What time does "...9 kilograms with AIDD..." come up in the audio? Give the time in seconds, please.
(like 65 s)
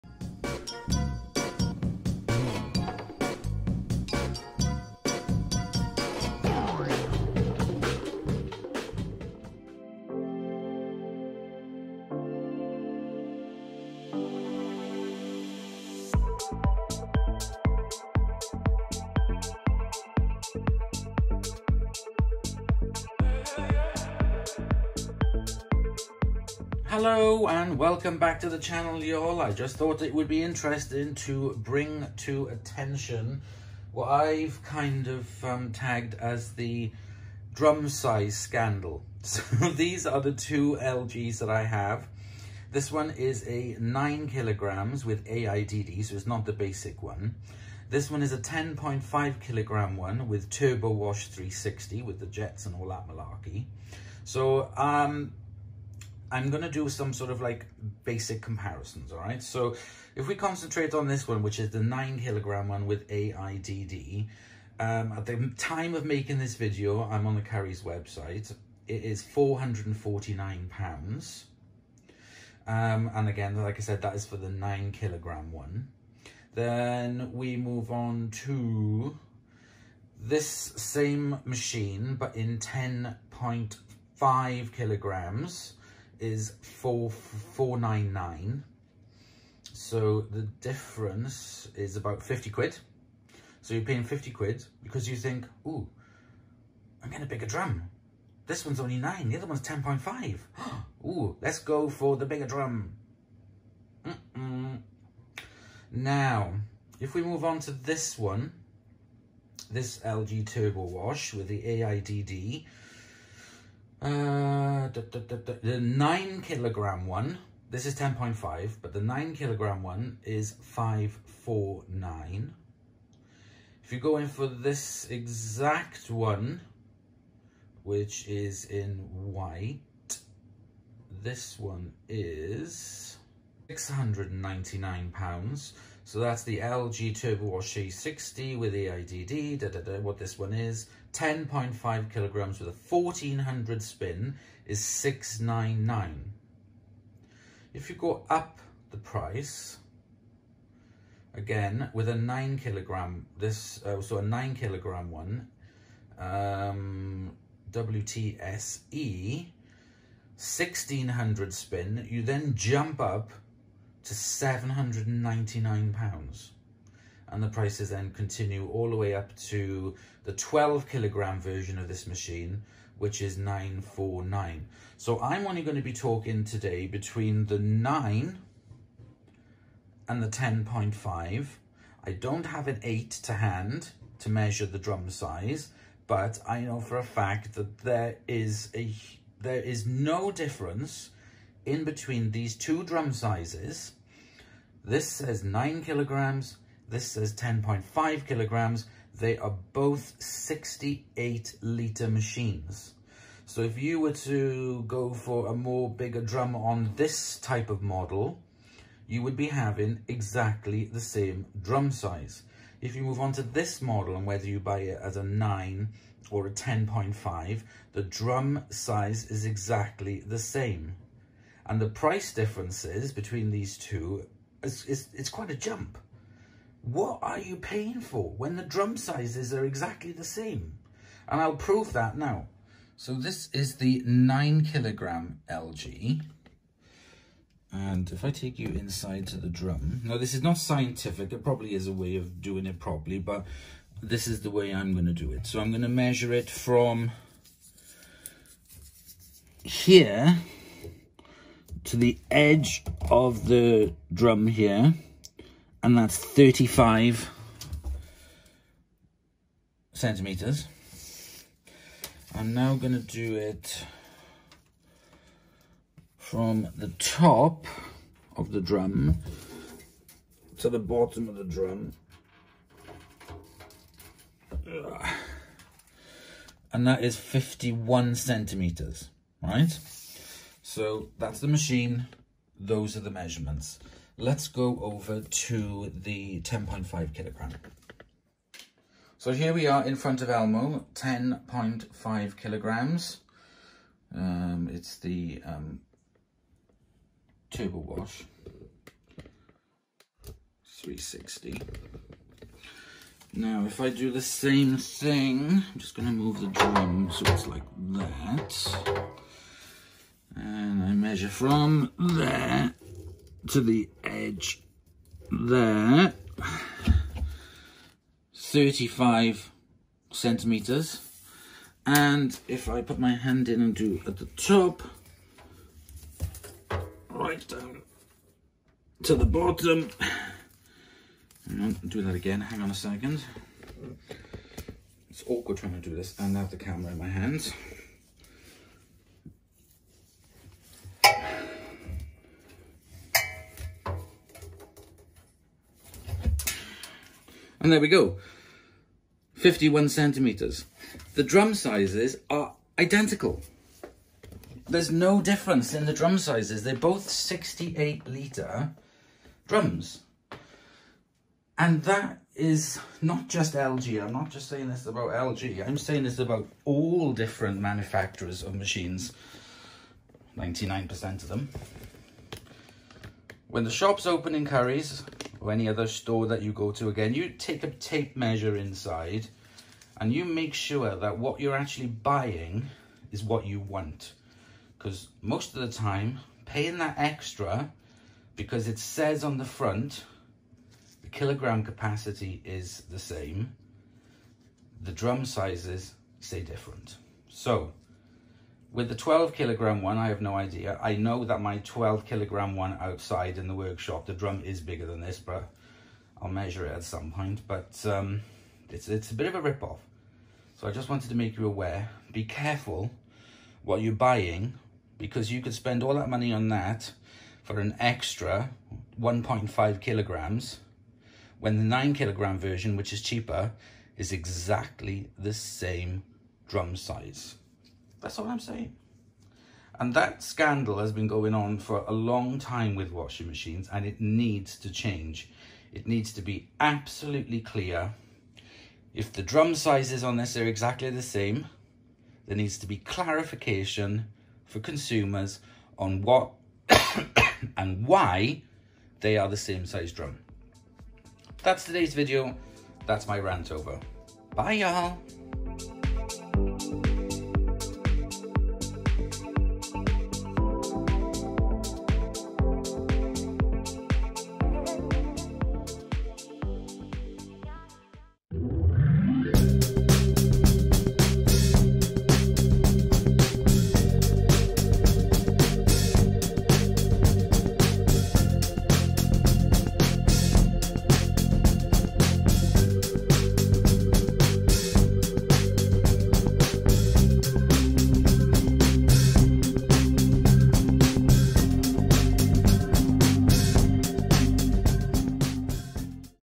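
43 s.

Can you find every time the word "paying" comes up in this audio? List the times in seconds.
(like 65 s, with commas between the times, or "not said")
93 s, 227 s, 386 s.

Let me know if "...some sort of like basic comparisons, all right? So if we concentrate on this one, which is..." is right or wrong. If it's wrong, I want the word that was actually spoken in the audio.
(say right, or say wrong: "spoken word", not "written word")
right.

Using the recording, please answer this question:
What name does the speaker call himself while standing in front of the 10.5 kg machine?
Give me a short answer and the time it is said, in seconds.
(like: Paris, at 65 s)
Elmo, at 290 s.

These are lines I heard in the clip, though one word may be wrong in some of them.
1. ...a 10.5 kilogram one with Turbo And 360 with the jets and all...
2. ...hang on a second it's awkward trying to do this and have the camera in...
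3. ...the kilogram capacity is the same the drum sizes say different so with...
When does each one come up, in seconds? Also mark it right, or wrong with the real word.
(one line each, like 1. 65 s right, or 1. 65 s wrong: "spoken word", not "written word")
1. 48 s wrong: "Wash", not "And"
2. 332 s right
3. 391 s right.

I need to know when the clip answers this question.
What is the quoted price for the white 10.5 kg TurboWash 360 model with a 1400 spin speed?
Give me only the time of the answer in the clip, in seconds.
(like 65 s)
133 s.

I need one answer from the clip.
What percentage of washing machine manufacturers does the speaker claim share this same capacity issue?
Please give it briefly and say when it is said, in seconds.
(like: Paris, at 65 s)
99%, at 370 s.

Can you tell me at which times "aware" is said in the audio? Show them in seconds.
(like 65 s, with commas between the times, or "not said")
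411 s.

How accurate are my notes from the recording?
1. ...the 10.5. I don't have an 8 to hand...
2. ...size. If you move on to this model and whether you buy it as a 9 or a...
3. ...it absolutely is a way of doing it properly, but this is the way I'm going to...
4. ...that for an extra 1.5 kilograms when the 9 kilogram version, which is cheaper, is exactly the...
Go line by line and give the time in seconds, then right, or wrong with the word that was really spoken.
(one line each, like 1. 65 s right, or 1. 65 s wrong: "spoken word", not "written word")
1. 180 s right
2. 211 s right
3. 241 s wrong: "probably", not "absolutely"
4. 416 s right.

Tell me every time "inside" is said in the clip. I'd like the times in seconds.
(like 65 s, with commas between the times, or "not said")
238 s, 378 s.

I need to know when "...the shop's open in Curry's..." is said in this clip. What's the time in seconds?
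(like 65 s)
373 s.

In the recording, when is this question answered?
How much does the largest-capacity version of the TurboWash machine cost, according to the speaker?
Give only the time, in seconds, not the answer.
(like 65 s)
173 s.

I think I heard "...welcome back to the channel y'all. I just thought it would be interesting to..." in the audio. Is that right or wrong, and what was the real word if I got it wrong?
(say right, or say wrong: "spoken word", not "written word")
right.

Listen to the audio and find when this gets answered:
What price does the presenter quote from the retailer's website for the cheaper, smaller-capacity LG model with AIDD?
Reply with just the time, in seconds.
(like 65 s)
69 s.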